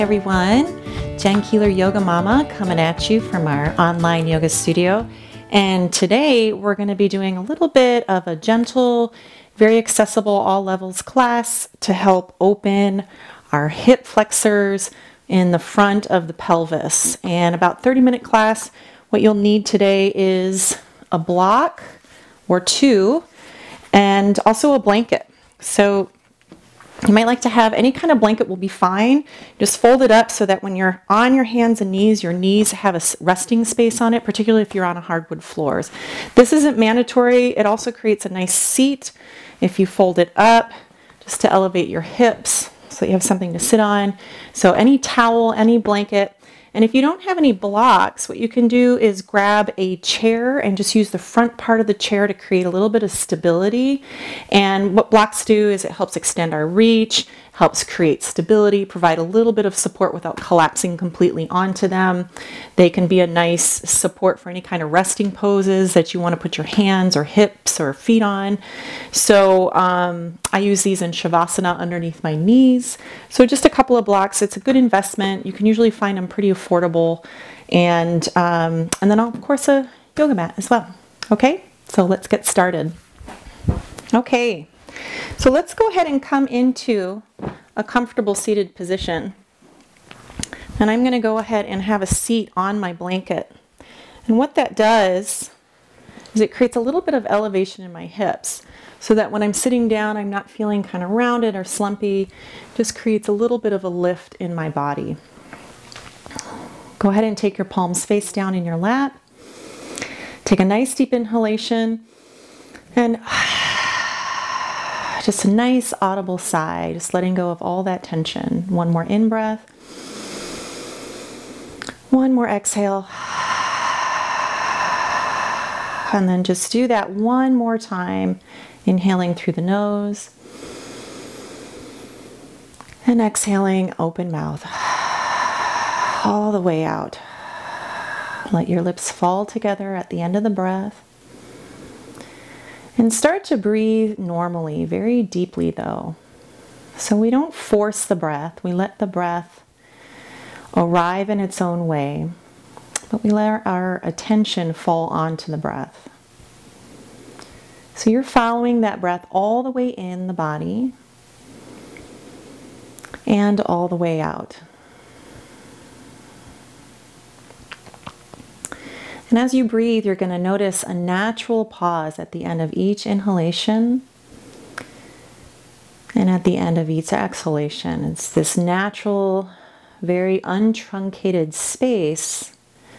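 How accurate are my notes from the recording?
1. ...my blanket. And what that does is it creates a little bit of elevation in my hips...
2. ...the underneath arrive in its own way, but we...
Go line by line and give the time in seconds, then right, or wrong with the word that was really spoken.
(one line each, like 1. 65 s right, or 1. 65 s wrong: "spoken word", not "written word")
1. 92 s right
2. 148 s wrong: "breath", not "underneath".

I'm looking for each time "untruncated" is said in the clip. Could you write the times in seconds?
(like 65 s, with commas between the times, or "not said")
180 s.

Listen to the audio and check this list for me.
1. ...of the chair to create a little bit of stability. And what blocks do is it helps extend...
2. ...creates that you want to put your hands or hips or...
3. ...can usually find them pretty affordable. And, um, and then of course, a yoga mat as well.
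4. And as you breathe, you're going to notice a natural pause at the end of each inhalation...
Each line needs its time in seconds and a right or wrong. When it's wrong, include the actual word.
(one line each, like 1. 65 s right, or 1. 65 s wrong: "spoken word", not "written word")
1. 51 s right
2. 65 s wrong: "poses", not "creates"
3. 75 s right
4. 169 s right.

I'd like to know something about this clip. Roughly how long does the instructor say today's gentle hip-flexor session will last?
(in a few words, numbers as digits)
30 minutes.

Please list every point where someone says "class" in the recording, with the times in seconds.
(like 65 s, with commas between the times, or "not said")
11 s, 18 s.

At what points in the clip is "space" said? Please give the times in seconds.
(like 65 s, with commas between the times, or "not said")
33 s, 181 s.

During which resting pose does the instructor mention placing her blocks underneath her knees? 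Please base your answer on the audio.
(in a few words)
Shavasana.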